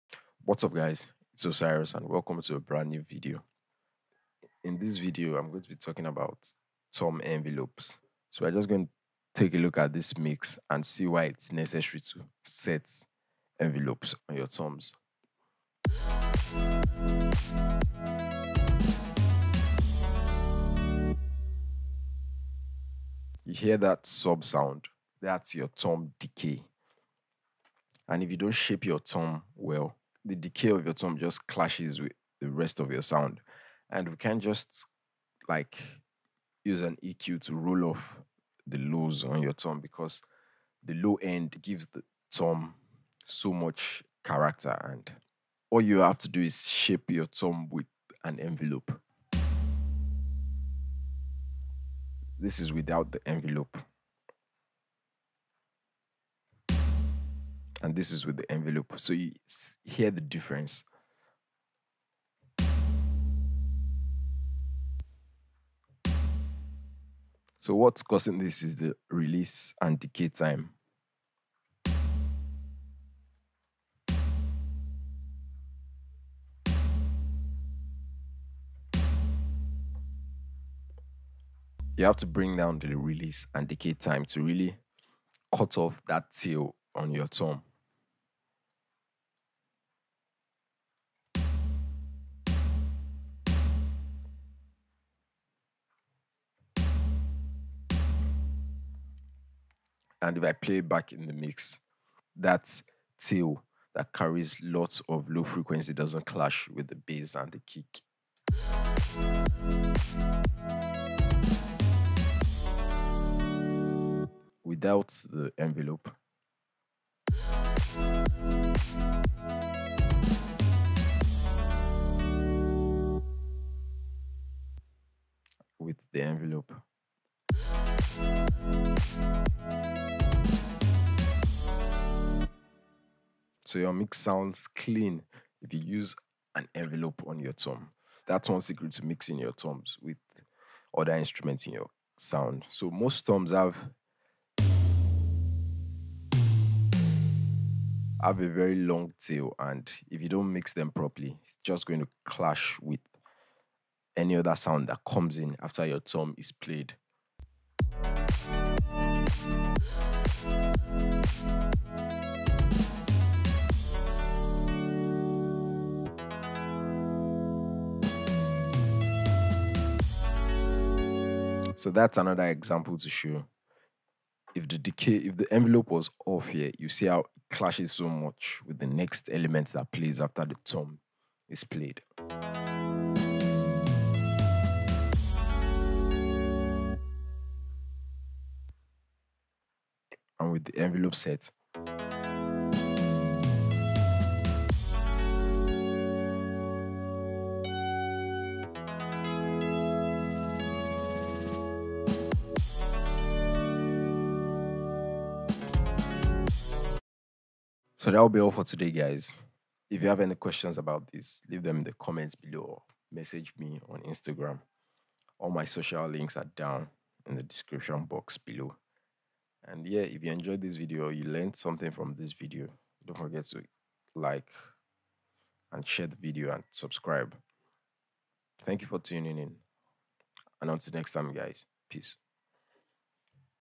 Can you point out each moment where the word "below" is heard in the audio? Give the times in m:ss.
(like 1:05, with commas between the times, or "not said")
3:32, 3:38.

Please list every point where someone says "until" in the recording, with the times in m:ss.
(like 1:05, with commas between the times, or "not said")
3:50.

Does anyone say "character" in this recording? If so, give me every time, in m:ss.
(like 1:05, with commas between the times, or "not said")
0:44.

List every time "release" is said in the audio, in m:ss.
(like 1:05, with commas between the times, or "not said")
1:09, 1:22.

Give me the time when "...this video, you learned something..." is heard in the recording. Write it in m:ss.
3:40.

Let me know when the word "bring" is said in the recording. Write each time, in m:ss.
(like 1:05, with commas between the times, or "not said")
1:22.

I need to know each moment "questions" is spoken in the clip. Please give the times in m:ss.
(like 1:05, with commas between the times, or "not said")
3:30.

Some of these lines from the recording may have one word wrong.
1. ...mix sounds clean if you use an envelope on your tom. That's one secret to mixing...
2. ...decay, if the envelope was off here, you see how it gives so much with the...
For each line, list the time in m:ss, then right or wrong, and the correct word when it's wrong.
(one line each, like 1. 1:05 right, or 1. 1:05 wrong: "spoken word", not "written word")
1. 2:13 right
2. 2:54 wrong: "clashes", not "gives".